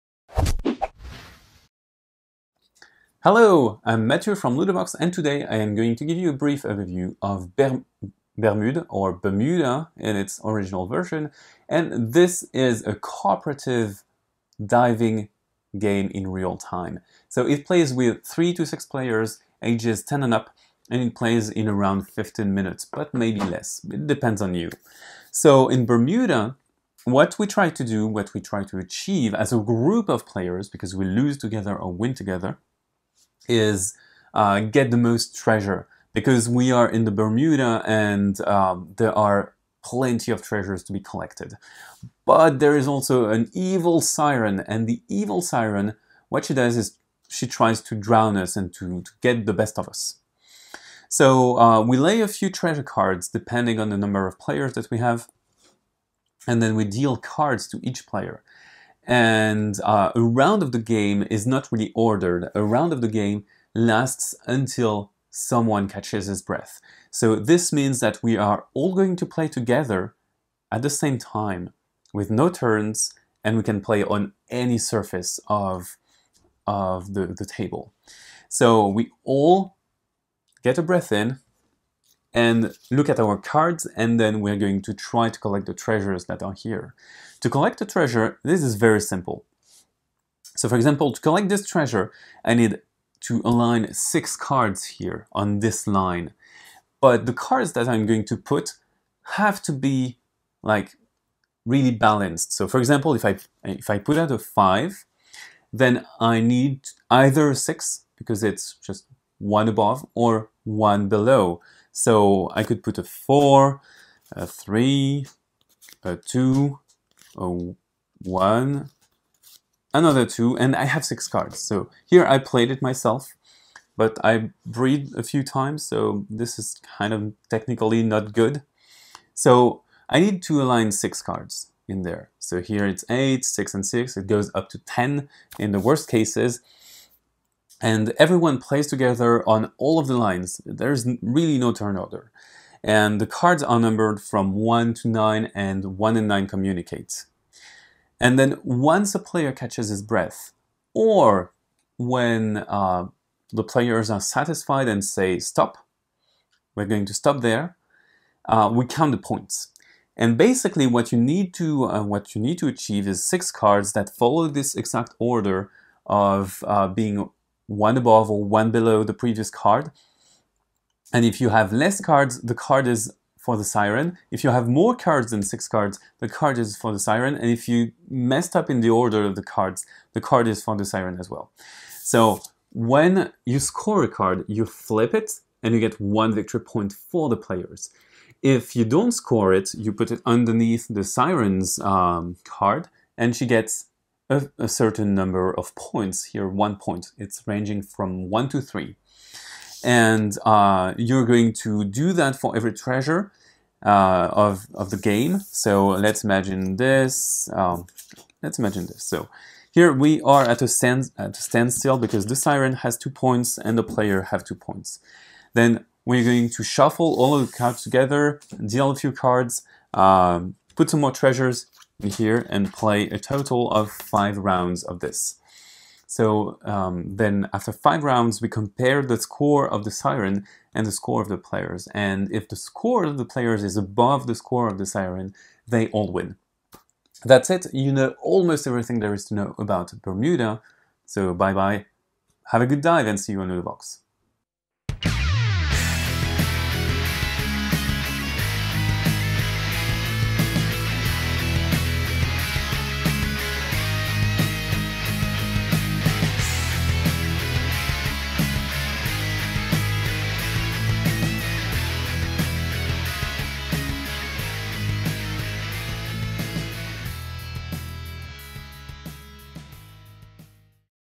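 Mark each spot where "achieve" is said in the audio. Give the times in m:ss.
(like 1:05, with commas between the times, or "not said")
0:28, 2:42.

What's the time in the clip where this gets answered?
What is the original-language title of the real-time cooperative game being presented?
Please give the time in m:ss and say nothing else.
0:09.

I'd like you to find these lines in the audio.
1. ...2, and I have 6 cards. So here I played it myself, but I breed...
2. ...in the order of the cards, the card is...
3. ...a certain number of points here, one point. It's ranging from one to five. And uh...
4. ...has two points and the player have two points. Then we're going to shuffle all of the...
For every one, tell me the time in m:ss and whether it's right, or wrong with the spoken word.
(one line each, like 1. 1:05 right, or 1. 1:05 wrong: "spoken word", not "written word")
1. 2:00 right
2. 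2:58 right
3. 3:14 wrong: "three", not "five"
4. 3:32 right.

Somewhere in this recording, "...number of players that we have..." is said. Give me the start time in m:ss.
0:53.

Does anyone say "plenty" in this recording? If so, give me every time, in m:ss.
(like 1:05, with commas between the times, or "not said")
0:39.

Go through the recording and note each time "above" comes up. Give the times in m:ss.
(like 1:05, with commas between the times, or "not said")
1:49, 2:47, 3:53.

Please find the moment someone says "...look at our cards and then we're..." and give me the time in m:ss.
1:22.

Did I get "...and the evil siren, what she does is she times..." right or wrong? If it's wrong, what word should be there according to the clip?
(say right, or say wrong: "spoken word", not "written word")
wrong: "tries", not "times".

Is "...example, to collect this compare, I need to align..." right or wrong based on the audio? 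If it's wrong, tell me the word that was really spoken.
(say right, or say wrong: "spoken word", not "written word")
wrong: "treasure", not "compare".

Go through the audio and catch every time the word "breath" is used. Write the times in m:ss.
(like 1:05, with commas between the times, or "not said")
1:06, 1:20, 2:30.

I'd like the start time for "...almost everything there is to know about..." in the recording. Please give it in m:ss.
3:58.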